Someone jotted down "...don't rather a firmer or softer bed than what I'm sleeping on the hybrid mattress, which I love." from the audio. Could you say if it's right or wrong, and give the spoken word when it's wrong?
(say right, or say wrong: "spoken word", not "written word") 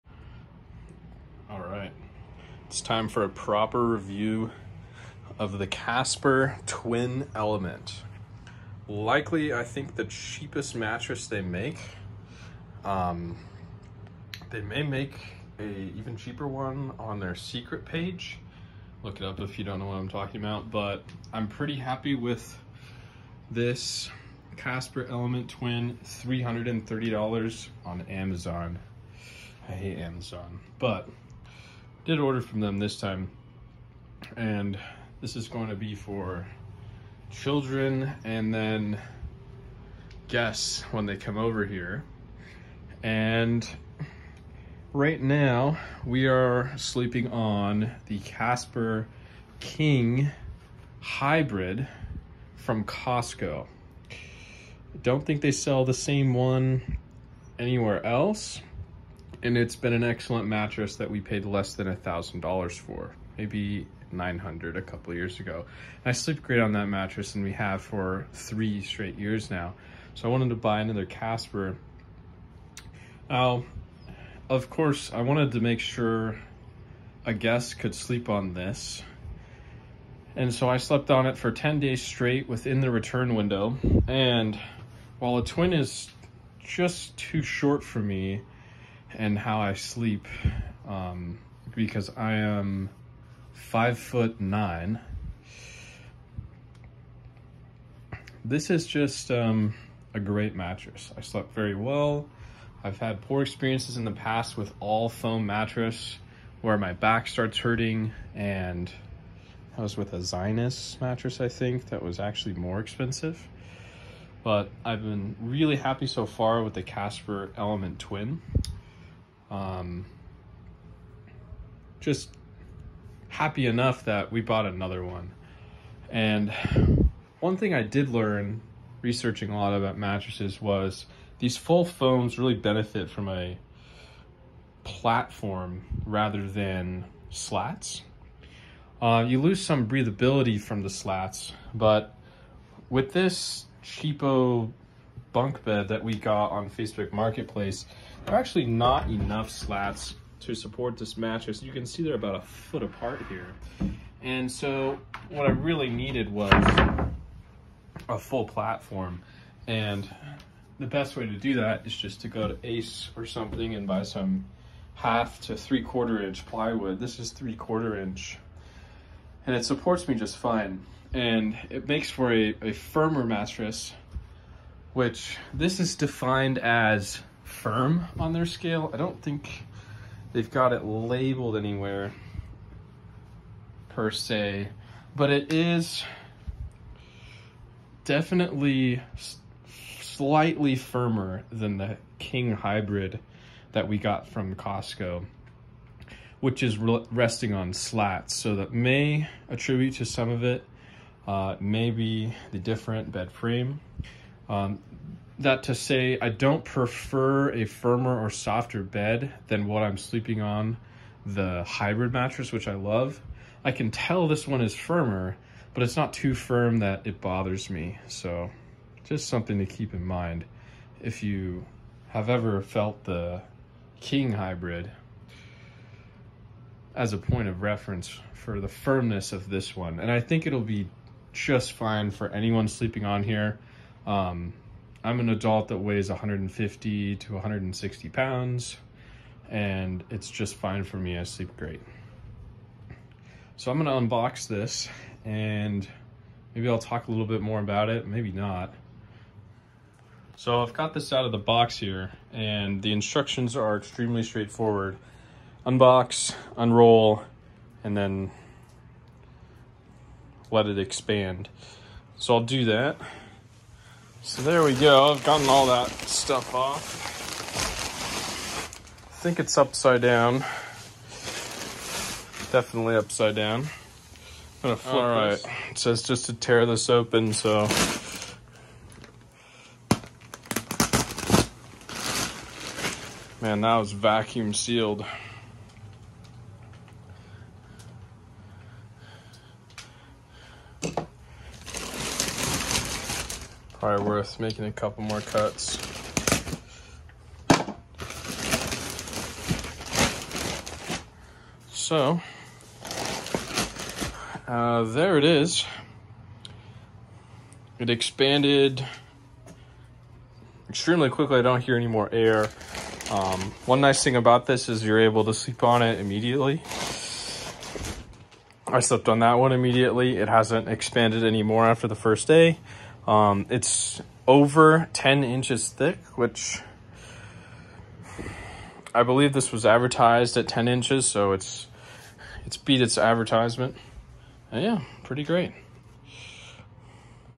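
wrong: "prefer", not "rather".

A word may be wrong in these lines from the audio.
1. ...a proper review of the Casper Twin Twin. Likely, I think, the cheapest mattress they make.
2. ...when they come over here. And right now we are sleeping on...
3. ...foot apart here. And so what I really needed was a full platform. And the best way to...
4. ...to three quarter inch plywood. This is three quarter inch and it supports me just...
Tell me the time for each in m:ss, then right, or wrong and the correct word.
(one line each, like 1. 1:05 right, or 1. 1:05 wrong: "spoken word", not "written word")
1. 0:03 wrong: "Element", not "Twin"
2. 0:40 right
3. 2:32 right
4. 2:45 right.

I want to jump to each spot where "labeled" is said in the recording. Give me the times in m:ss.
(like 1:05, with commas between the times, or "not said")
3:00.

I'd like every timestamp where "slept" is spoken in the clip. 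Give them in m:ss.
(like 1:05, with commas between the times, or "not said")
1:20, 1:41, 5:18.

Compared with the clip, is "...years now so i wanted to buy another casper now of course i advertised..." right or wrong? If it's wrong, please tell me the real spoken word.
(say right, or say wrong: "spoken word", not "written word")
wrong: "wanted", not "advertised".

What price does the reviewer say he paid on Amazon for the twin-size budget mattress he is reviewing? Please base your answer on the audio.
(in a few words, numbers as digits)
$330.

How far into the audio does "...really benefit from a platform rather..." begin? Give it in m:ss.
2:12.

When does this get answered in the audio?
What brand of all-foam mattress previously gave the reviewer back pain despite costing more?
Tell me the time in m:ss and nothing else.
1:50.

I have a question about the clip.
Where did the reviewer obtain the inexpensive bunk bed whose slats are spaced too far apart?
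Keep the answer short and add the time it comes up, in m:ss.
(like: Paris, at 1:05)
Facebook Marketplace, at 2:26.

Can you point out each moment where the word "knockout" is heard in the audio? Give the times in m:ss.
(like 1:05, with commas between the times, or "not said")
not said.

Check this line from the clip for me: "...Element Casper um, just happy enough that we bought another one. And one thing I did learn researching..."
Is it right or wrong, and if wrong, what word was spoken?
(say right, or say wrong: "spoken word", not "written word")
wrong: "Twin", not "Casper".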